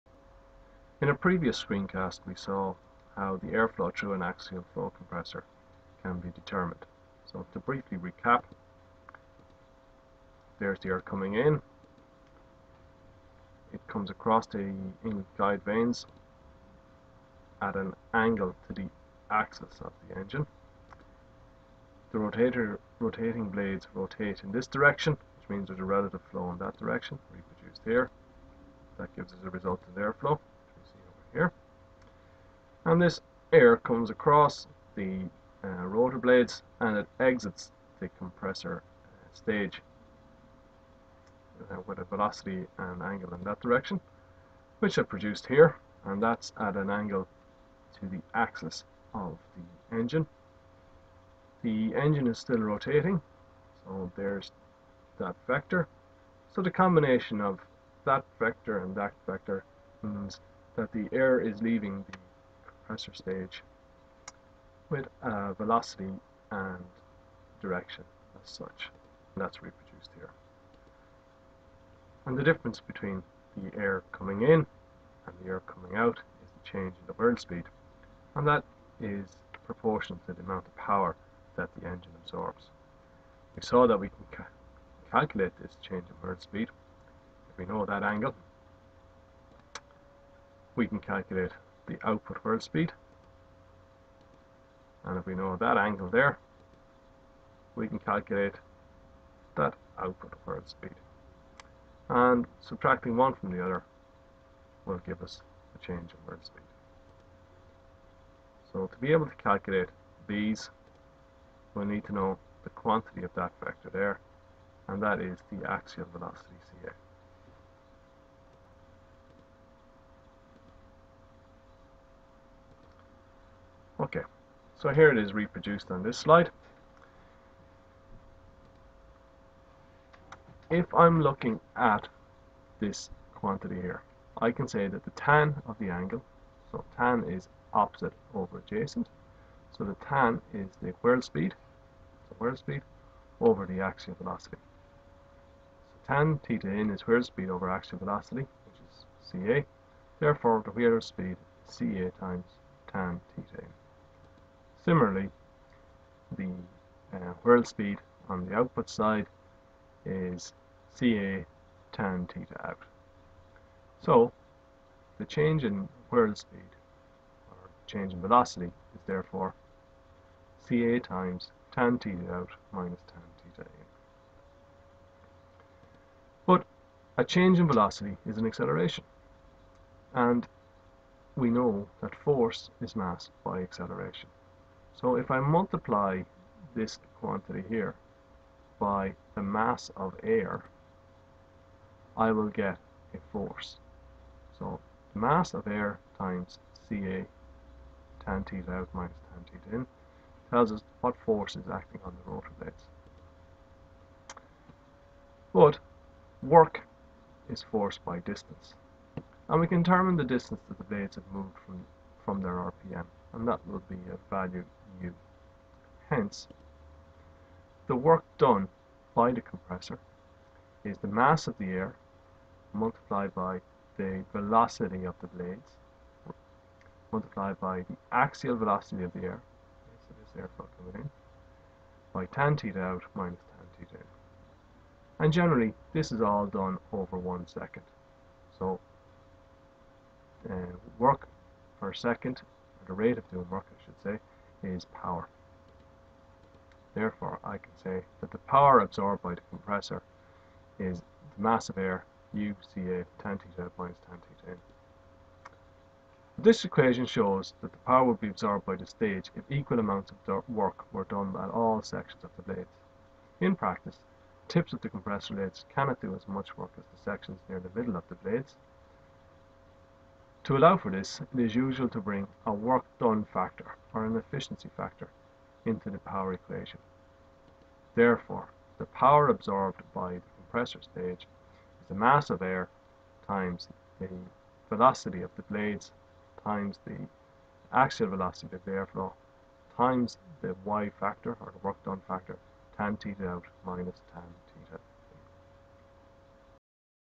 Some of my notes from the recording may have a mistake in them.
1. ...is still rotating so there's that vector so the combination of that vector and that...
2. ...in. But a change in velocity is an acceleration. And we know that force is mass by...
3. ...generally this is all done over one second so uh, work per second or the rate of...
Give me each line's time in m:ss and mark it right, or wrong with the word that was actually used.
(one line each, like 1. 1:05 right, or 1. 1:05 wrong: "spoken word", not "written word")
1. 0:52 right
2. 2:53 right
3. 3:55 right.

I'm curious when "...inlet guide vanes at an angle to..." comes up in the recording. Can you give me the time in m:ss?
0:15.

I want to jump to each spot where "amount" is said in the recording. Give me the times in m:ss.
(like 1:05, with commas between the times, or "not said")
1:20, 4:19.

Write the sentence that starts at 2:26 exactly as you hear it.
So tan theta in is whirl speed over axial velocity, which is CA.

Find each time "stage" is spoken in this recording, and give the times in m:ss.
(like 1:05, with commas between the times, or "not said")
0:39, 1:03, 4:18, 4:40.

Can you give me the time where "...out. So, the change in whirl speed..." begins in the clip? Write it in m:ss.
2:42.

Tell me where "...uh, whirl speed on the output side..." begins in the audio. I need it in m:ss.
2:37.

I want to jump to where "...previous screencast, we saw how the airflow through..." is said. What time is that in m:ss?
0:01.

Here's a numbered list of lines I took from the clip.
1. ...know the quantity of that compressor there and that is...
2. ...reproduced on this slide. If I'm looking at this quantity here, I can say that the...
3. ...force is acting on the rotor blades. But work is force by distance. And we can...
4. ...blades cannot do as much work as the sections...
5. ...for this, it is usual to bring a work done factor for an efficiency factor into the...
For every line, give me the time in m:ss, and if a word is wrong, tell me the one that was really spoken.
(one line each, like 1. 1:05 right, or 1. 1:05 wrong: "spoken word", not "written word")
1. 1:52 wrong: "vector", not "compressor"
2. 2:05 right
3. 3:21 right
4. 4:25 right
5. 4:30 right.